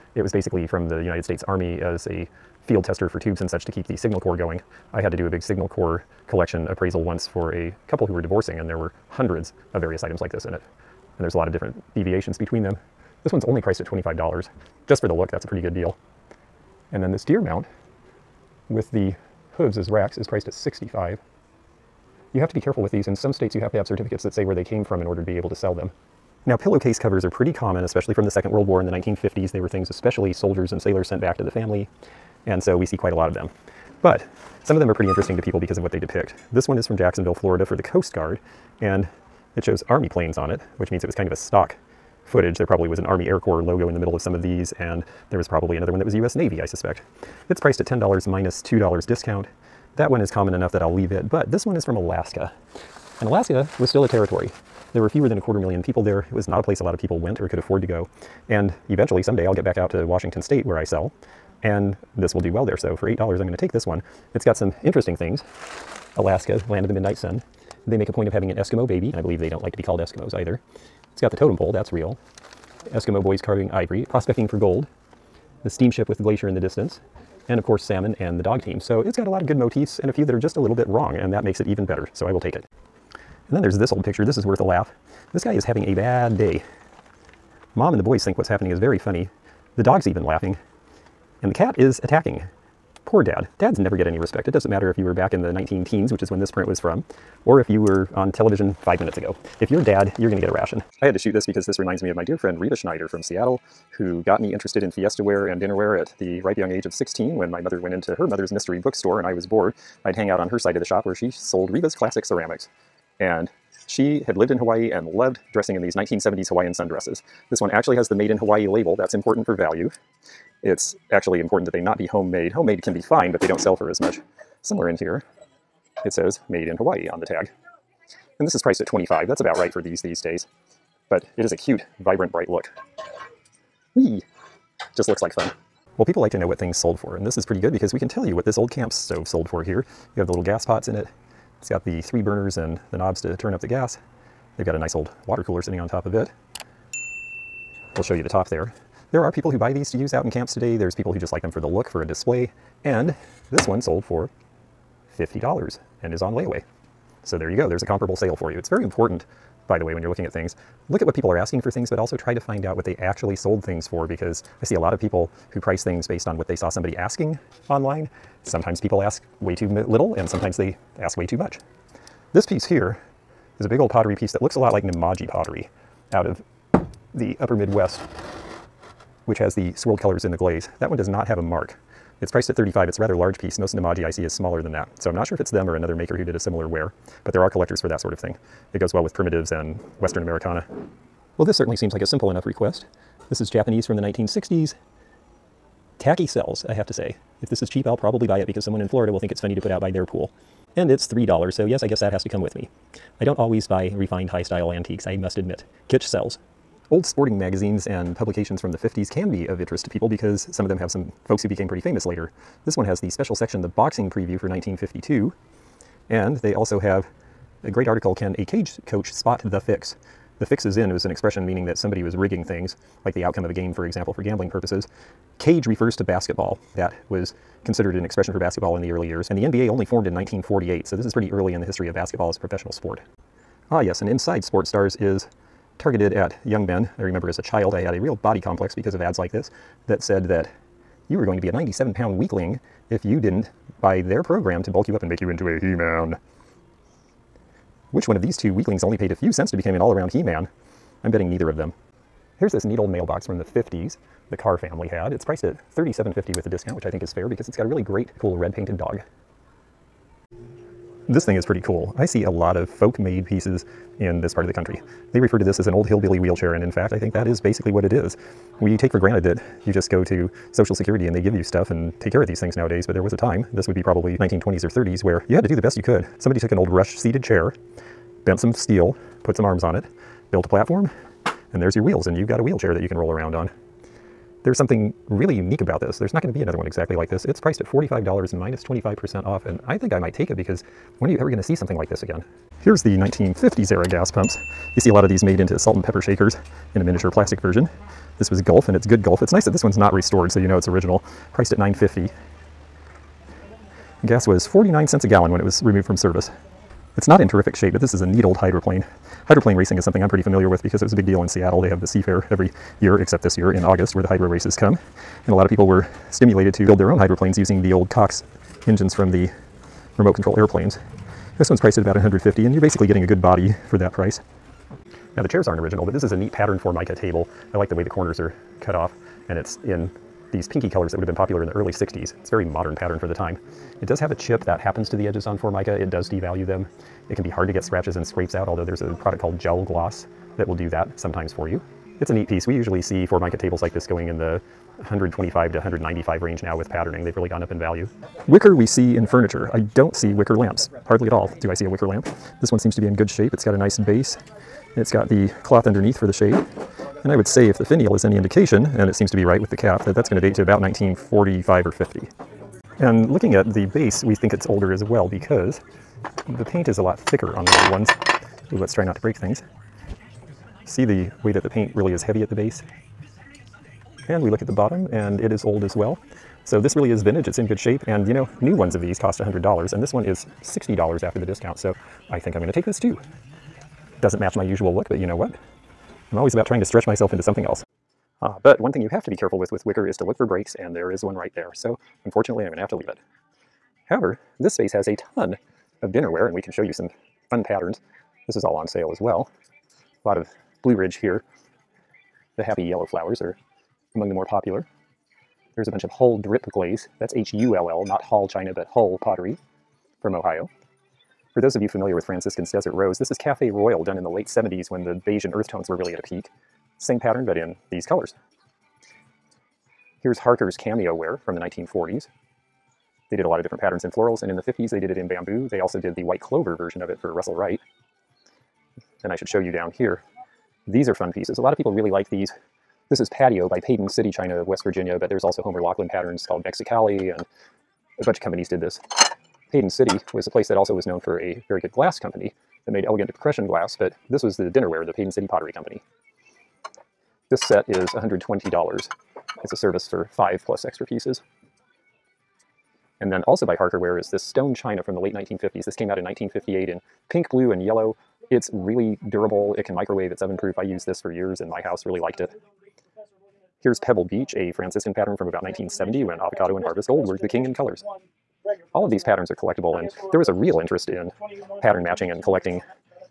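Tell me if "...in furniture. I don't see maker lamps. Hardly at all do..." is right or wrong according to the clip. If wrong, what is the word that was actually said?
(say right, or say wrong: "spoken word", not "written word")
wrong: "wicker", not "maker".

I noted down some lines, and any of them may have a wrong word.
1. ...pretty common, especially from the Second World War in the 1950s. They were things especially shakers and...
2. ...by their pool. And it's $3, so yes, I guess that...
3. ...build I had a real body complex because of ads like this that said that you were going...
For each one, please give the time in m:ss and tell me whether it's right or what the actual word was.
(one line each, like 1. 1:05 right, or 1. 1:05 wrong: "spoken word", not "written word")
1. 0:27 wrong: "soldiers", not "shakers"
2. 3:19 right
3. 3:57 wrong: "child", not "build".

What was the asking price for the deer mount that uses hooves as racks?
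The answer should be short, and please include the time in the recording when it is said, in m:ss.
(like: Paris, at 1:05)
$65, at 0:20.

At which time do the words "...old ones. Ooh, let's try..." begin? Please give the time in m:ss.
6:07.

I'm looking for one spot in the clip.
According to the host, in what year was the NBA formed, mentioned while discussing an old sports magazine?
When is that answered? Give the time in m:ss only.
3:50.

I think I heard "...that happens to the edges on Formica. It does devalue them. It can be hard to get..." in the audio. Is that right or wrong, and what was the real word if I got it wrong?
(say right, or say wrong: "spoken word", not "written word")
right.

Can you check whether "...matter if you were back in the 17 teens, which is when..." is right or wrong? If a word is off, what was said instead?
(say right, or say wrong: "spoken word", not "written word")
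wrong: "19", not "17".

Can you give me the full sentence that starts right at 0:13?
This one's only priced at $25.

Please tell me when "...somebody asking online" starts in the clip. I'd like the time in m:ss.
2:46.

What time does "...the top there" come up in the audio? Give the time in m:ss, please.
2:28.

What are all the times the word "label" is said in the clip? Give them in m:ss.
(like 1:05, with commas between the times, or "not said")
1:58.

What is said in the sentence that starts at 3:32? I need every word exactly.
This one has the special section, the boxing preview for 1952.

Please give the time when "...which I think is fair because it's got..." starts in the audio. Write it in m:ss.
4:16.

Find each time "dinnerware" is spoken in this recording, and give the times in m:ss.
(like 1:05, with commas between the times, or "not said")
1:45, 6:35, 7:24.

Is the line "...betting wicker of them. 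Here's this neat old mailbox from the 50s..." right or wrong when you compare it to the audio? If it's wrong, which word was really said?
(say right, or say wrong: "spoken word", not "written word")
wrong: "neither", not "wicker".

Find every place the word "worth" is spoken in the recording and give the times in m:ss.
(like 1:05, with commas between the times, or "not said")
1:24.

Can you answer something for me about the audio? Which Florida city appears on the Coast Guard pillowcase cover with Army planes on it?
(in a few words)
Jacksonville.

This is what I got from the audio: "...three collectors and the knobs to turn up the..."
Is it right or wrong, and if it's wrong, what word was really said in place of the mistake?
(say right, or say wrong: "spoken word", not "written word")
wrong: "burners", not "collectors".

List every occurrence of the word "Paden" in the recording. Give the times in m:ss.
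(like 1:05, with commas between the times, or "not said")
7:13, 7:19, 7:24.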